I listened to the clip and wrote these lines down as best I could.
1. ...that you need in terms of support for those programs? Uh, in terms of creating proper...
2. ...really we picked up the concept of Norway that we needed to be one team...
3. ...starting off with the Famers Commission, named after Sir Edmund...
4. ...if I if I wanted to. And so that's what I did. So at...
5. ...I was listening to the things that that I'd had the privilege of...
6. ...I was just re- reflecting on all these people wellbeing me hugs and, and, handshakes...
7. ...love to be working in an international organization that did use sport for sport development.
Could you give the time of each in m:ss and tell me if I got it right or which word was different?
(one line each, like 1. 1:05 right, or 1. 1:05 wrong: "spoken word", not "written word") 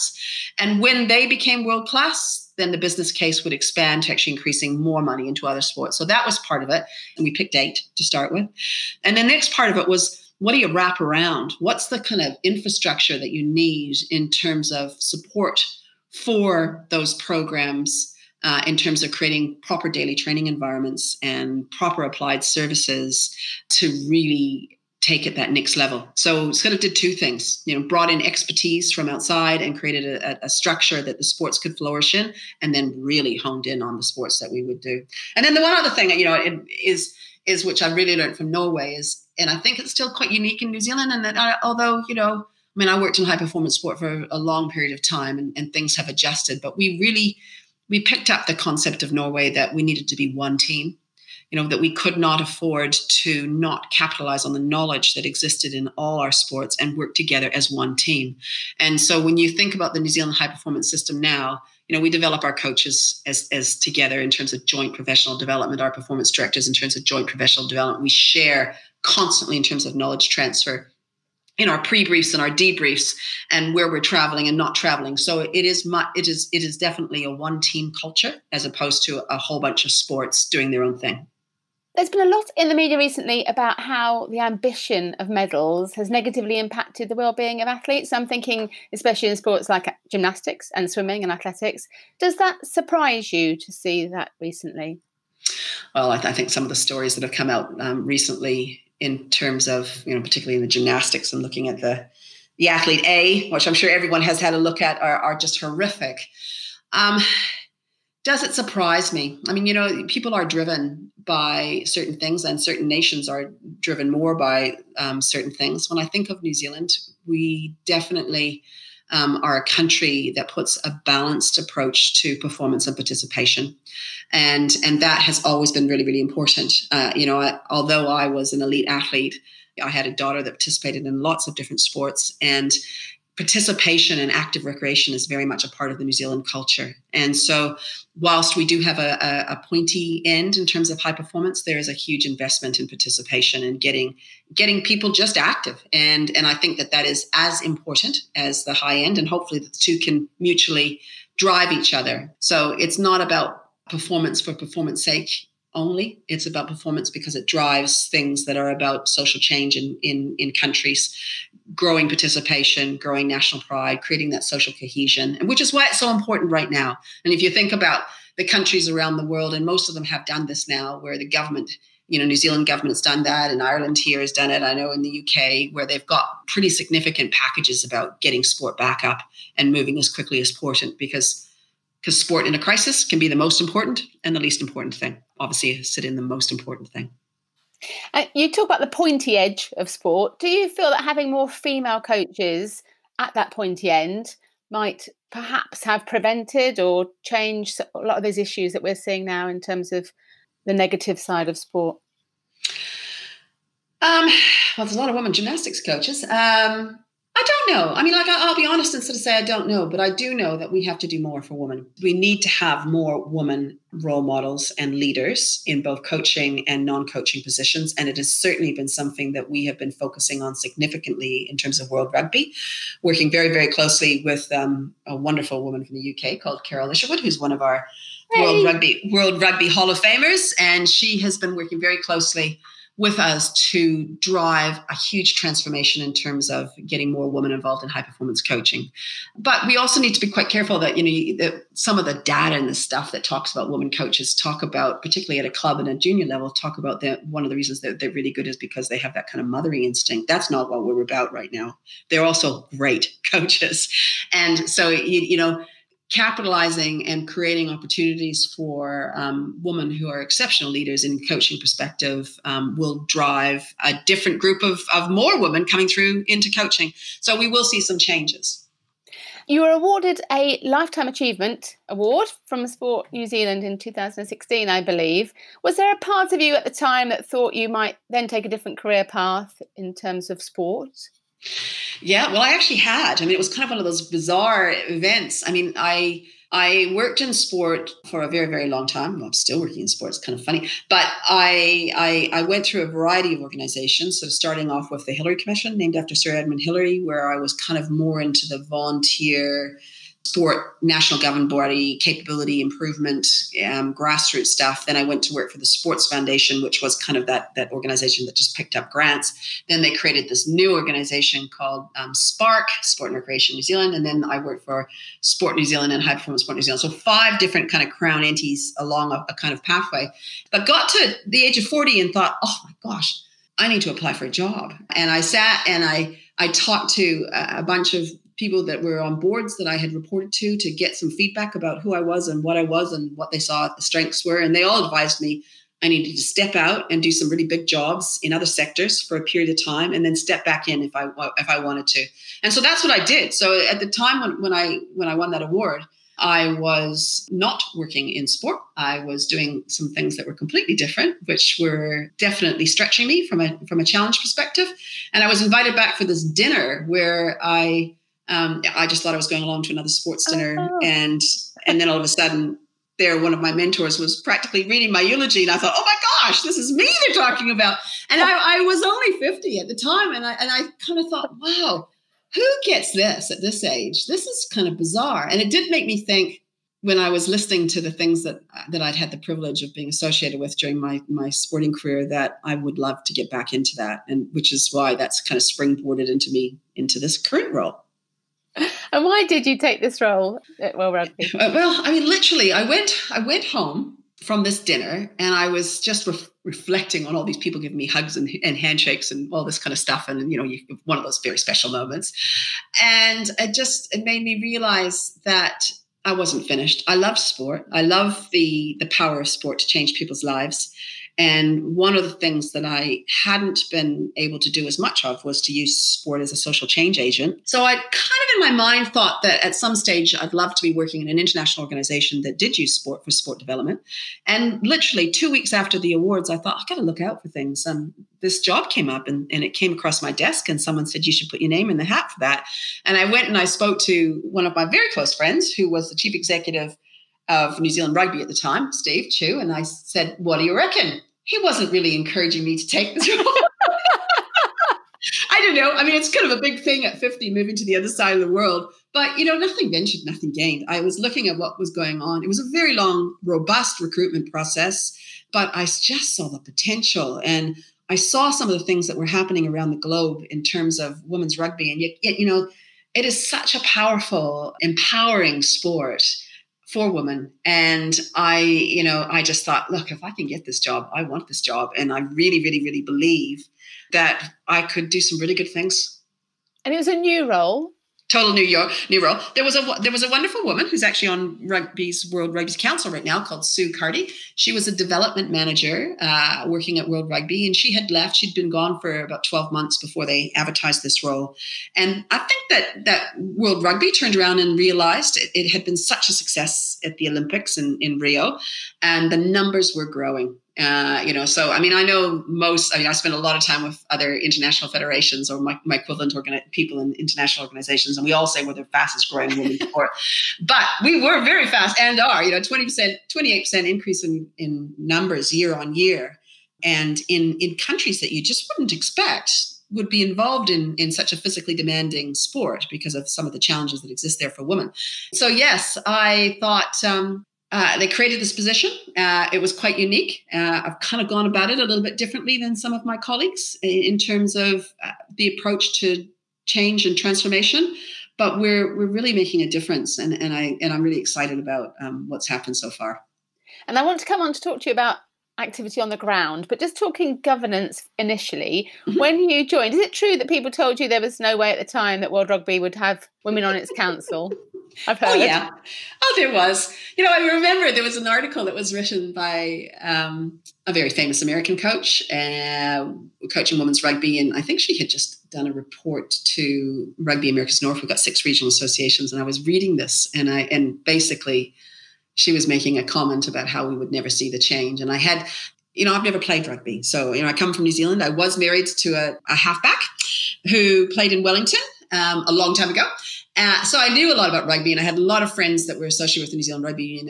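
1. 0:13 right
2. 0:46 right
3. 4:54 wrong: "Hillary", not "Famers"
4. 5:40 right
5. 6:16 right
6. 6:35 wrong: "giving", not "wellbeing"
7. 7:00 right.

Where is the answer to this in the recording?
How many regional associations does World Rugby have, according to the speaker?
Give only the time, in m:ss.
9:27.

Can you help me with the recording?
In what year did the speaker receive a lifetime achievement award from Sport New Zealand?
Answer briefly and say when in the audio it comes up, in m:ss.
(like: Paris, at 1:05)
2016, at 4:33.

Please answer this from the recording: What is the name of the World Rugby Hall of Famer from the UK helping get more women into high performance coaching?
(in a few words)
Carol Isherwood.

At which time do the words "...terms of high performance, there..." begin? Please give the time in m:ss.
2:20.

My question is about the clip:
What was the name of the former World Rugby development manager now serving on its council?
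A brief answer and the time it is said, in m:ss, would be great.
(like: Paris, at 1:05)
Sue Carty, at 8:03.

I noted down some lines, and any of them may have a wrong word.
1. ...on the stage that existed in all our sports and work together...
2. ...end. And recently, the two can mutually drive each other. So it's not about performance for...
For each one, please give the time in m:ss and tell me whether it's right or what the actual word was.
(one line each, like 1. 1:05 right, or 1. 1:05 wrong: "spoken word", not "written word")
1. 0:54 wrong: "knowledge", not "stage"
2. 2:28 wrong: "hopefully", not "recently".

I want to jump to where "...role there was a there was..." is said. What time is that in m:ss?
7:59.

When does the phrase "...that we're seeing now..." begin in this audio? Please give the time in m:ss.
3:18.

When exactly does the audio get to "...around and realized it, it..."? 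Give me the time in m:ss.
8:14.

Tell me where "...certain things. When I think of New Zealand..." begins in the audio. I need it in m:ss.
1:55.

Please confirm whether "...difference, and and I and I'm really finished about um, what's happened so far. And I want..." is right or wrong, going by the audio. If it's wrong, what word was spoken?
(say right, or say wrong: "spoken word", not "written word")
wrong: "excited", not "finished".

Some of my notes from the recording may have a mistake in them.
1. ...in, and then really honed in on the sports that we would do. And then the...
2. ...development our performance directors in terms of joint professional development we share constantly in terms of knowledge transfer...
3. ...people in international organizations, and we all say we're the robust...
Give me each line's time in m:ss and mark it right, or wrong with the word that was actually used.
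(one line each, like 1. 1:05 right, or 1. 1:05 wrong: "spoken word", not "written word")
1. 0:32 right
2. 1:05 right
3. 8:26 wrong: "fastest", not "robust".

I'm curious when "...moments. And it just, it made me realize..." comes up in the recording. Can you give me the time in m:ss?
6:41.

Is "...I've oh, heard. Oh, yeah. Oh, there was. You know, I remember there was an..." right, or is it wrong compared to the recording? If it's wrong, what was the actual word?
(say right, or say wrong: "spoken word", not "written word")
right.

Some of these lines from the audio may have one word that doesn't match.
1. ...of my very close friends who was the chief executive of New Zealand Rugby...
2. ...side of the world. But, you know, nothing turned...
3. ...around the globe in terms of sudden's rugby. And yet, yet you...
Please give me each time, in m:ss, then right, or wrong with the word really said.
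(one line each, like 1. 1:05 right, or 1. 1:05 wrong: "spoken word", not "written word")
1. 7:14 right
2. 7:27 wrong: "ventured", not "turned"
3. 7:39 wrong: "women", not "sudden".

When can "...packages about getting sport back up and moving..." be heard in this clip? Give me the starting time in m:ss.
2:57.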